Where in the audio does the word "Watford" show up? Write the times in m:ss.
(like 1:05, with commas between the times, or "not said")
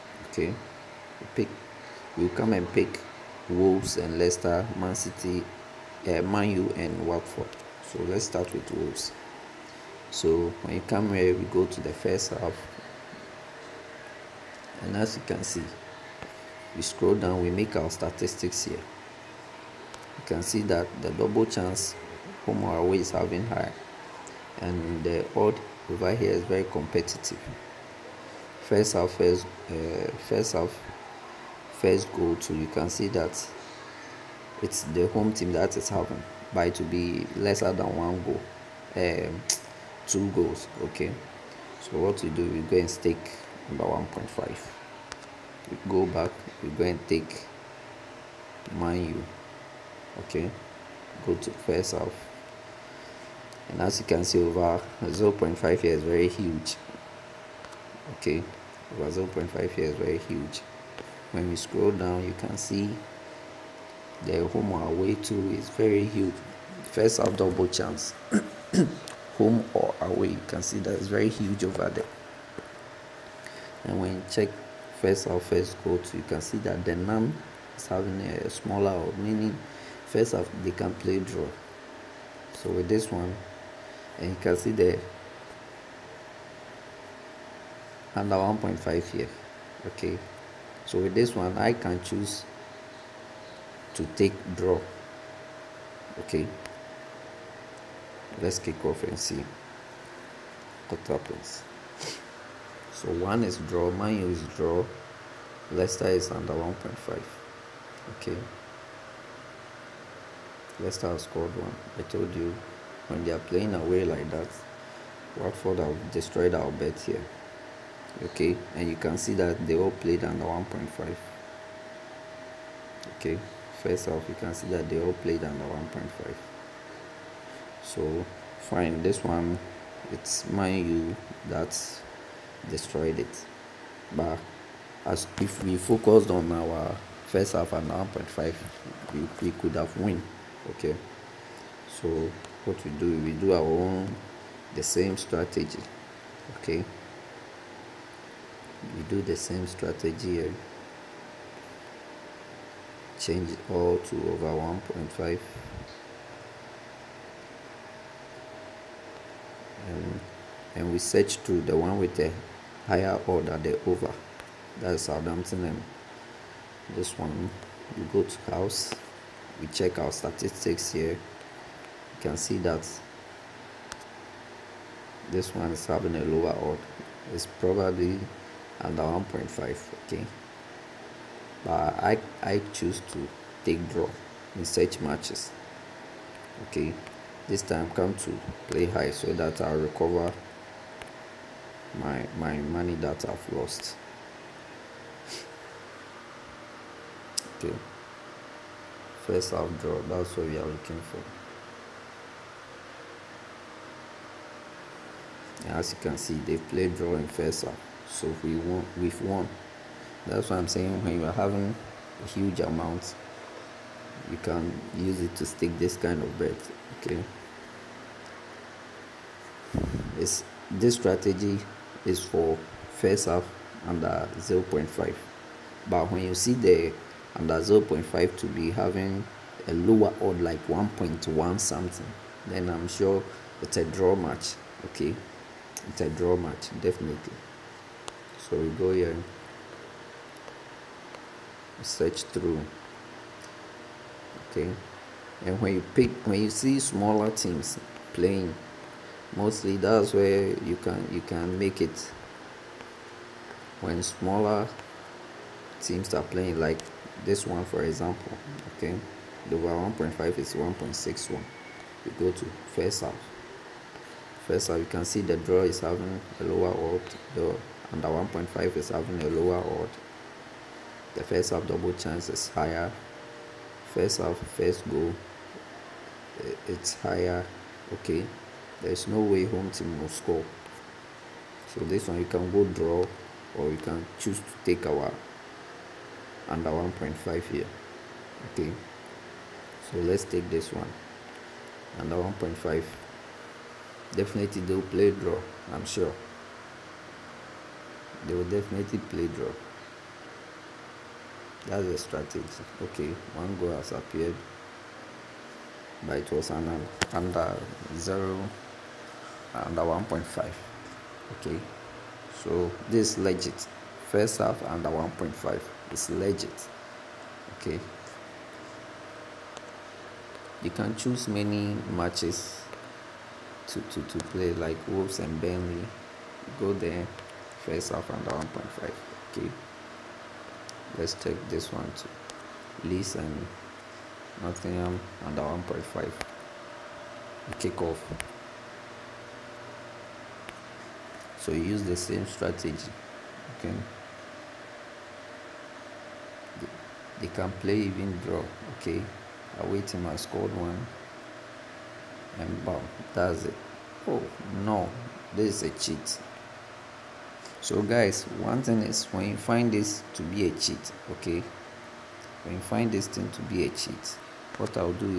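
0:07, 1:55.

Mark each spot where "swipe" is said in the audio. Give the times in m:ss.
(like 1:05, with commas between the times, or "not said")
not said.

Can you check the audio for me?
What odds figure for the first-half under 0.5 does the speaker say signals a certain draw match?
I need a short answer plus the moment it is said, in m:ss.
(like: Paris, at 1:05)
1.1, at 3:50.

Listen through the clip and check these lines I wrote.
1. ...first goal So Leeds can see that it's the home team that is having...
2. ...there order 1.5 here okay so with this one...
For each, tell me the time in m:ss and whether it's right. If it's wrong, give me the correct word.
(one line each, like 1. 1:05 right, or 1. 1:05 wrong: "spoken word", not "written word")
1. 0:31 wrong: "You", not "Leeds"
2. 1:24 wrong: "under", not "order".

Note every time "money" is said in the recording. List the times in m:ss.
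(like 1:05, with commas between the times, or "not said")
3:12.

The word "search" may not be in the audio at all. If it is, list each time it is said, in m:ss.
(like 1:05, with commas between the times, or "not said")
2:40, 4:01.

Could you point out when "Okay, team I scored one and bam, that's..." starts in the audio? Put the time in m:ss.
5:48.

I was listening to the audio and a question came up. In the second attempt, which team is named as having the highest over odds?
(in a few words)
Southampton.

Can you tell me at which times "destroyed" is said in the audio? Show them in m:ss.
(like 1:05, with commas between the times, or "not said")
1:56, 2:12.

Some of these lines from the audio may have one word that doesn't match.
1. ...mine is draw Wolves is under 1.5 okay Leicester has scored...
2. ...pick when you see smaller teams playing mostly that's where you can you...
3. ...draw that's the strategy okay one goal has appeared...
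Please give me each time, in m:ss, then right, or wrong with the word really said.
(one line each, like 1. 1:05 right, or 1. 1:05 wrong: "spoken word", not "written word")
1. 1:43 wrong: "Leicester", not "Wolves"
2. 4:05 right
3. 4:59 right.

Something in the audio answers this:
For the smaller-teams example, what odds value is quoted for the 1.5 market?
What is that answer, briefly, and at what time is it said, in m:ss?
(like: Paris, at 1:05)
1.61, at 4:20.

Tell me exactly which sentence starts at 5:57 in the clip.
So guys, one thing is when you find this to be a cheat, okay?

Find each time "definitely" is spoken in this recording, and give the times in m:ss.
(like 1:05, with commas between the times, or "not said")
3:56, 4:54, 4:58.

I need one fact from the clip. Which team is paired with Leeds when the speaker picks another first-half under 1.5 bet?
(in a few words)
Nottingham.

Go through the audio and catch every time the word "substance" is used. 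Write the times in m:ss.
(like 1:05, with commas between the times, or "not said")
not said.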